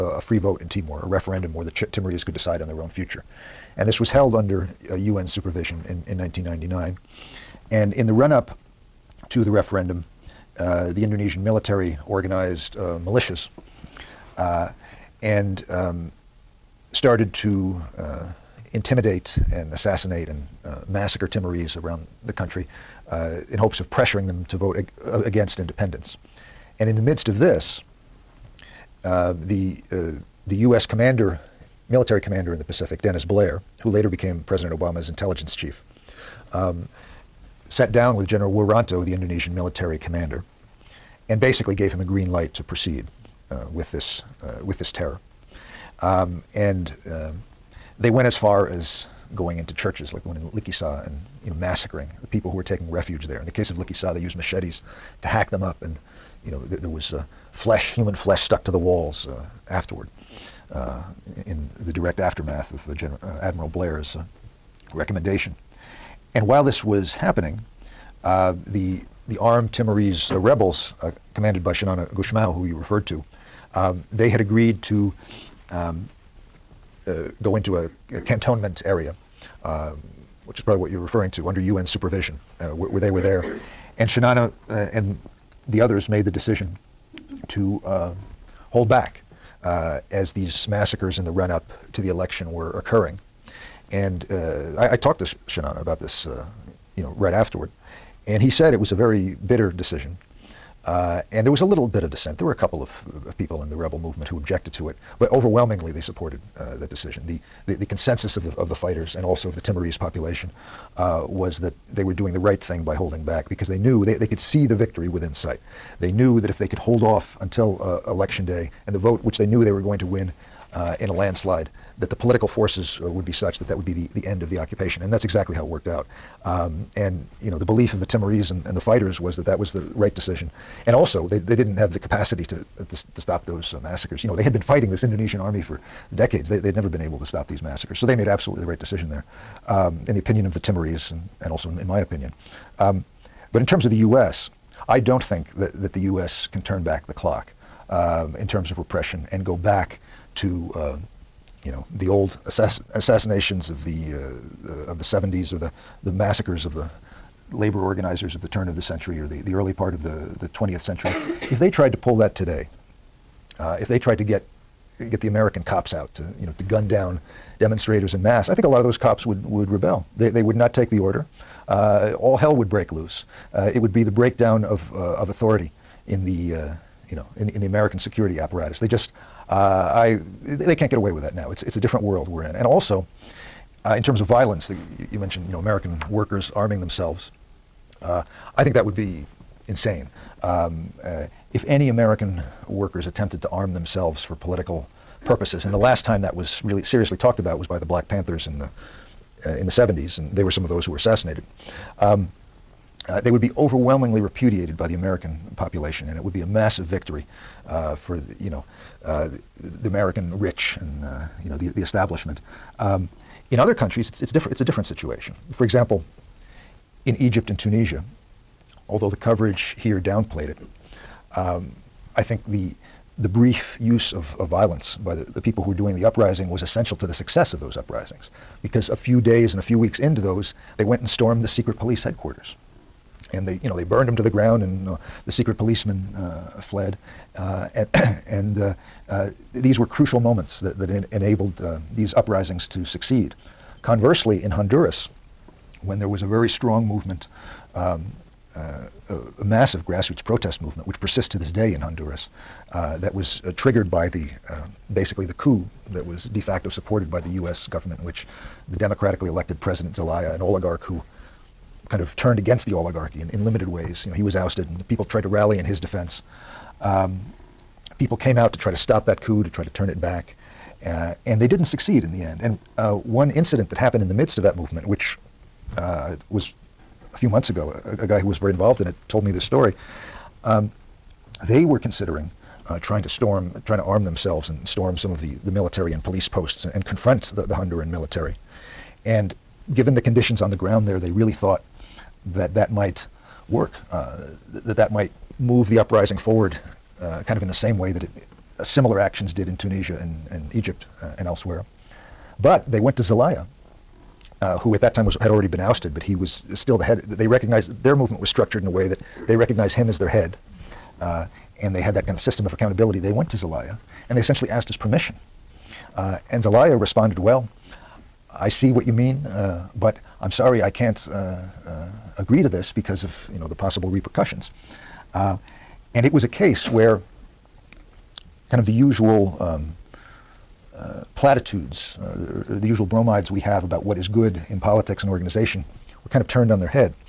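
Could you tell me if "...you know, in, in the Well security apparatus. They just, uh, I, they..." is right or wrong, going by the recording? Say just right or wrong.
wrong.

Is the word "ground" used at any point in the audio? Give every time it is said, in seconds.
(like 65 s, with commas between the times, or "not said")
234 s, 290 s.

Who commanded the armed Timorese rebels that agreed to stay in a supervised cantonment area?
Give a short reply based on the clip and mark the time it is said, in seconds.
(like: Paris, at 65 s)
Xanana Gusmão, at 71 s.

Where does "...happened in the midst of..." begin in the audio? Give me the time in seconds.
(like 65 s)
273 s.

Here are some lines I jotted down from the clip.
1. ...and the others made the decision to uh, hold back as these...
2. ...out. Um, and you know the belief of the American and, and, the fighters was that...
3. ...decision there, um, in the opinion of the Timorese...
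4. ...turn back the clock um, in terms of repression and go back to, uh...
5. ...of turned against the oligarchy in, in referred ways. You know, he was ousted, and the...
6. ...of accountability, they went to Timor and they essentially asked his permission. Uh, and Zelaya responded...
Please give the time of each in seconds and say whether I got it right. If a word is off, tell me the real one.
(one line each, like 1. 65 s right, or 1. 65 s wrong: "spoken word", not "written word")
1. 84 s right
2. 125 s wrong: "Timorese", not "American"
3. 138 s right
4. 146 s right
5. 261 s wrong: "limited", not "referred"
6. 312 s wrong: "Zelaya", not "Timor".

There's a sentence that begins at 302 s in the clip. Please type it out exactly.
But they went to Zelaya, uh, who at that time was had already been ousted, but he was still the head.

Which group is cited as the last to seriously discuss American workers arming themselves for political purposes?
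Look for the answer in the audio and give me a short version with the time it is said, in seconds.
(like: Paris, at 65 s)
The Black Panthers, at 197 s.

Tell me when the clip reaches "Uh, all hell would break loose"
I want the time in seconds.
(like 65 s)
171 s.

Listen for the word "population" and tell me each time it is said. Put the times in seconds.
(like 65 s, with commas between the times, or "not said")
109 s, 205 s.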